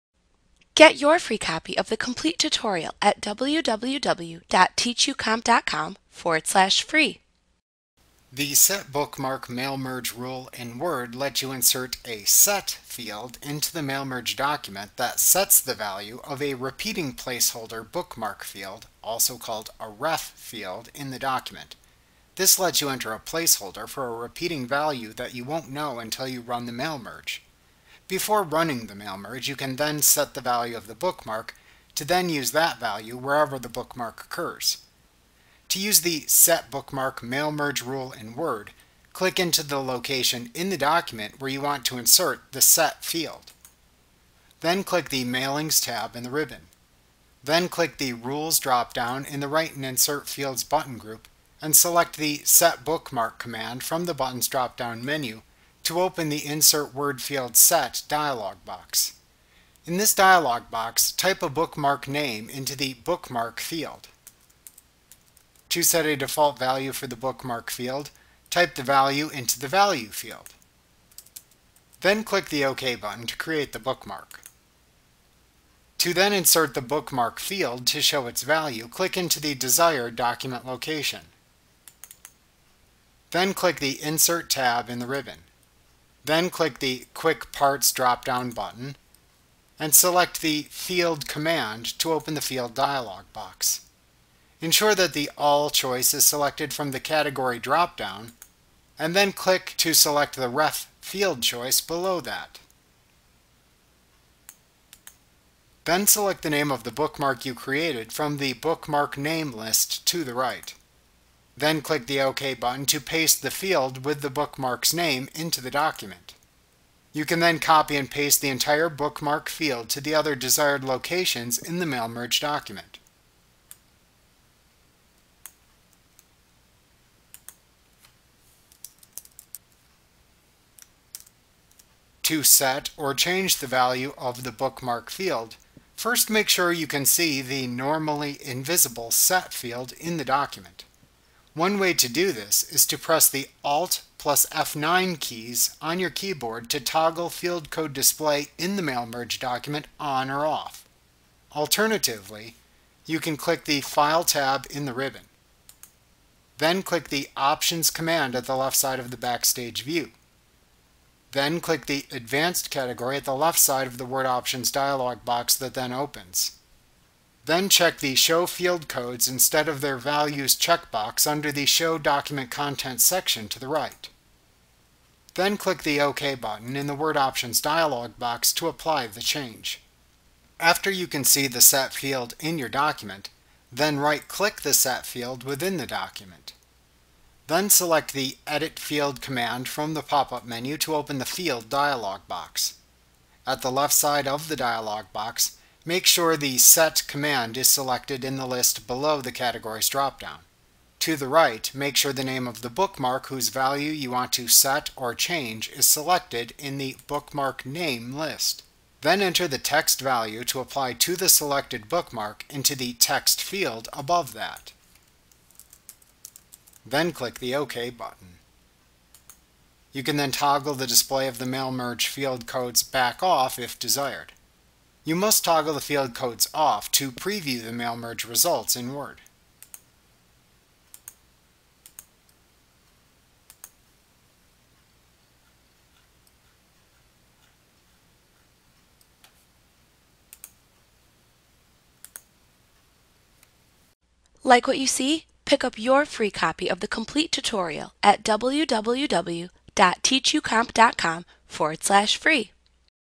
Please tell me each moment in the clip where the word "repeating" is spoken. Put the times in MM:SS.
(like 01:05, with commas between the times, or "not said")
00:16, 00:24.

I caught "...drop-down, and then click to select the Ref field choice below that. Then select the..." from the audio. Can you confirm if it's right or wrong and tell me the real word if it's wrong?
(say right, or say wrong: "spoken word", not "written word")
right.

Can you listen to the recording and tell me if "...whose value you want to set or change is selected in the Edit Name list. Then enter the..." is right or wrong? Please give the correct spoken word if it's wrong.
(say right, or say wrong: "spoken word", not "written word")
wrong: "Bookmark", not "Edit".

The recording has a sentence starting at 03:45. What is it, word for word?
You must toggle the field codes off to preview the mail merge results in Word.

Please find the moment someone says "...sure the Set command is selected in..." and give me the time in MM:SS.
03:16.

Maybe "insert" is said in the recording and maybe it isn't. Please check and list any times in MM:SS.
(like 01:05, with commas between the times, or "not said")
00:11, 00:41, 00:49, 00:56, 01:16, 01:24.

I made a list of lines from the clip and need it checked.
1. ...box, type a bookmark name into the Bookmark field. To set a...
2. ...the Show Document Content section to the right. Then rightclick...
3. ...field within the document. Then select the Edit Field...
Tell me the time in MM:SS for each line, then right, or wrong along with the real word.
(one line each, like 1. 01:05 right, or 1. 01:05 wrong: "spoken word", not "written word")
1. 01:00 right
2. 02:51 wrong: "click", not "rightclick"
3. 03:05 right.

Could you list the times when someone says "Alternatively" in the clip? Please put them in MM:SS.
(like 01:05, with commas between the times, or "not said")
02:31.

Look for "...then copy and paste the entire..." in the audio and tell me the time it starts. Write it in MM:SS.
01:57.